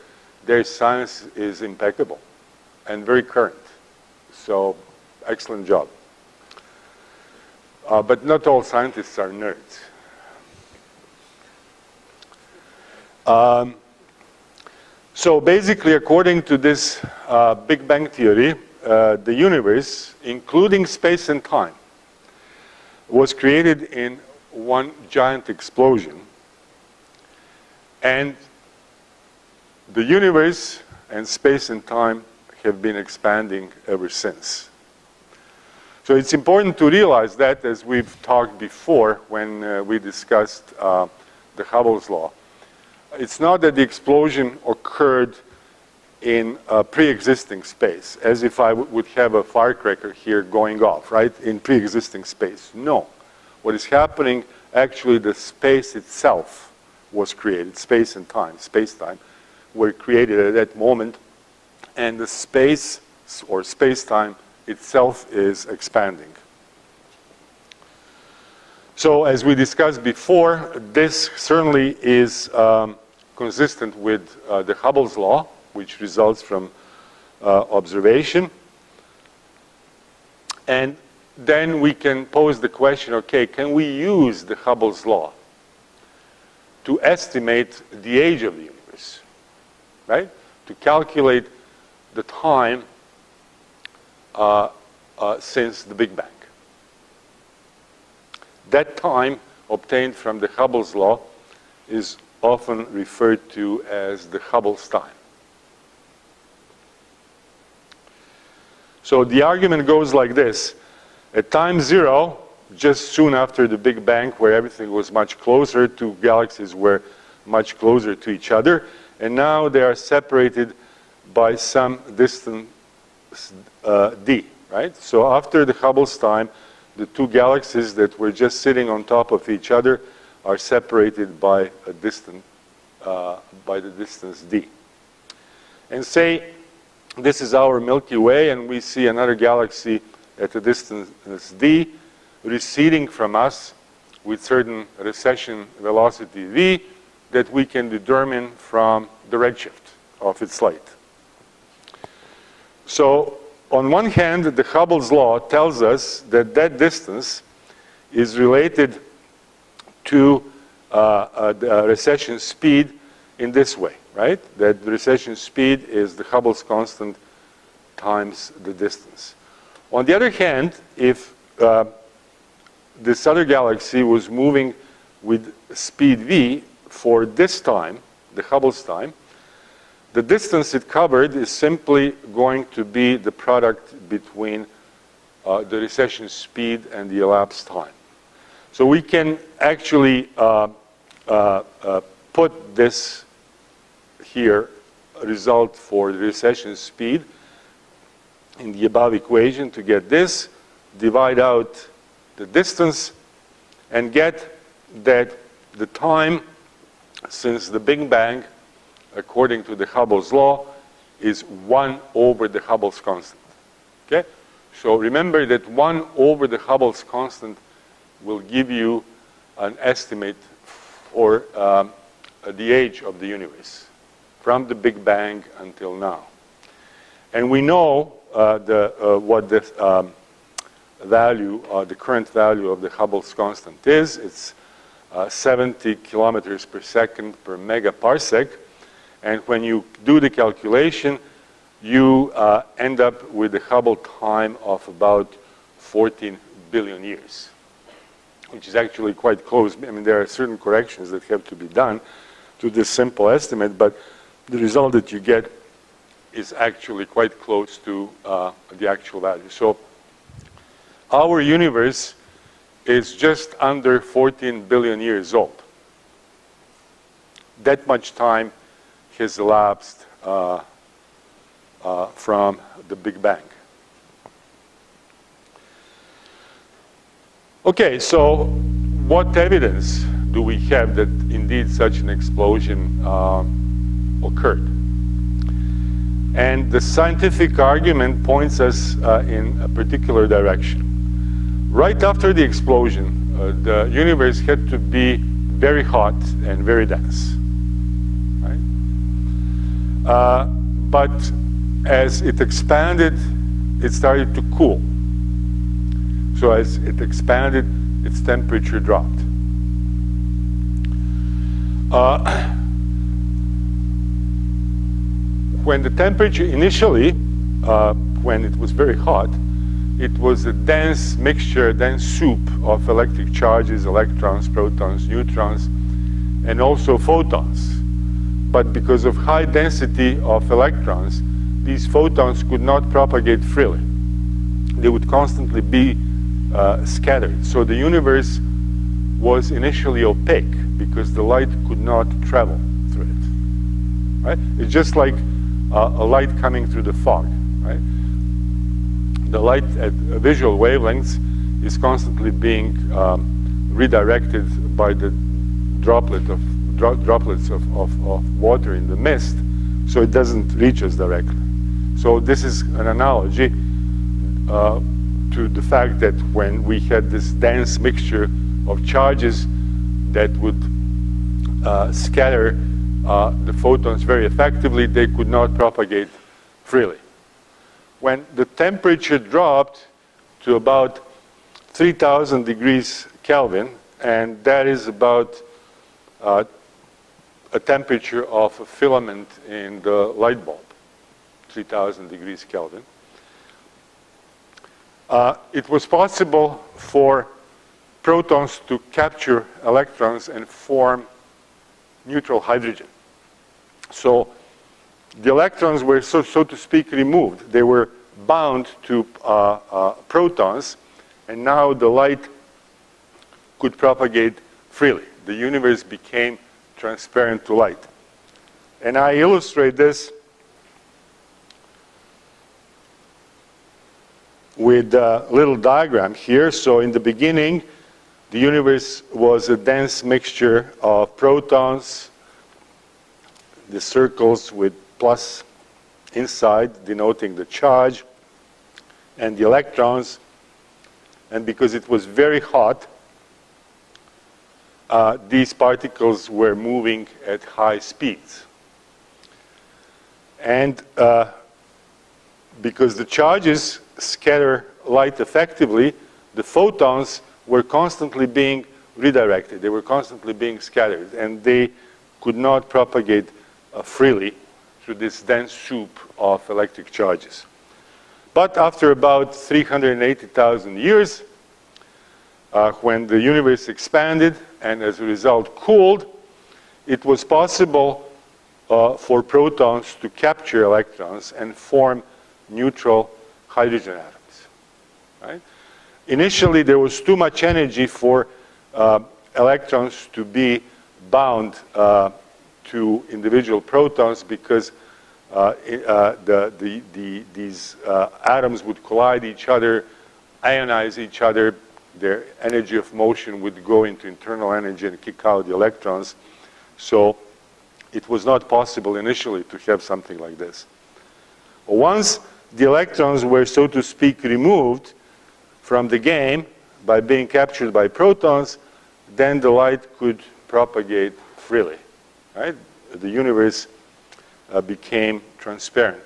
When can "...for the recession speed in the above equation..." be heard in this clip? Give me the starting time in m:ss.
3:15.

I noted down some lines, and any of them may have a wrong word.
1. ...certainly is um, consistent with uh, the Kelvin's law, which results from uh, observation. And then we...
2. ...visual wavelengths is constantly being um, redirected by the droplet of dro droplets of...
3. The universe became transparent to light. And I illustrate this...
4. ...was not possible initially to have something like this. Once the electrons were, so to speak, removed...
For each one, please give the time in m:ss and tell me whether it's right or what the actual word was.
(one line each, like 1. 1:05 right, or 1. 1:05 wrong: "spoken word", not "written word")
1. 1:11 wrong: "Hubble", not "Kelvin"
2. 5:50 right
3. 6:55 right
4. 8:28 right.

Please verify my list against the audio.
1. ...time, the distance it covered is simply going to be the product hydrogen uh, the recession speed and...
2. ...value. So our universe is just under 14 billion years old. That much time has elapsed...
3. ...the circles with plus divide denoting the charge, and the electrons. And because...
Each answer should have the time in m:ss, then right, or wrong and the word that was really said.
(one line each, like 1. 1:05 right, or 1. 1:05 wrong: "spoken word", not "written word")
1. 2:58 wrong: "between", not "hydrogen"
2. 4:19 right
3. 7:13 wrong: "inside", not "divide".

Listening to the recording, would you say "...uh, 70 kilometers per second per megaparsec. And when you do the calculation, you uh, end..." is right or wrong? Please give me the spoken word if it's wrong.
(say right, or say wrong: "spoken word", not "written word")
right.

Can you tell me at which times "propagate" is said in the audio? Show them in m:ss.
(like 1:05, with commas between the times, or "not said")
5:32, 6:15, 6:53, 7:42, 8:40.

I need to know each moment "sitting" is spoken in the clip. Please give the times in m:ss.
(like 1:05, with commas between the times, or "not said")
2:08.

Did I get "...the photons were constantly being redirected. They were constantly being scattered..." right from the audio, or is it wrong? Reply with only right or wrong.
right.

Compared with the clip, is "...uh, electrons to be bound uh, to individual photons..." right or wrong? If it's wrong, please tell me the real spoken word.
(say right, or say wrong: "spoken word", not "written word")
wrong: "protons", not "photons".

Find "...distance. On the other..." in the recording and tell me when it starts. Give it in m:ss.
2:48.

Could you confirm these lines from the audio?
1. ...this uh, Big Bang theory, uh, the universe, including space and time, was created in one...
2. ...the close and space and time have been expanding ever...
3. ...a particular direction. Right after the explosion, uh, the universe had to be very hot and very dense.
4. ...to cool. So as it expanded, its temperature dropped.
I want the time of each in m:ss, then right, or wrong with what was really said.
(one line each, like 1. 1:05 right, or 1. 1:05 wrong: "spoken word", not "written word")
1. 0:16 right
2. 0:29 wrong: "universe", not "close"
3. 4:49 right
4. 5:04 right.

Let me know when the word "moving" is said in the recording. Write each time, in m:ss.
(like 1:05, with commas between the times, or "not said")
2:54, 7:26.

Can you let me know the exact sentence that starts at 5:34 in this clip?
They would constantly be uh, scattered.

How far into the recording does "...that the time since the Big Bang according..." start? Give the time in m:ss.
3:25.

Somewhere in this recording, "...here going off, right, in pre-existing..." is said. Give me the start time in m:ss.
0:50.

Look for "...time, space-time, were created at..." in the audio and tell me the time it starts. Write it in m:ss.
0:58.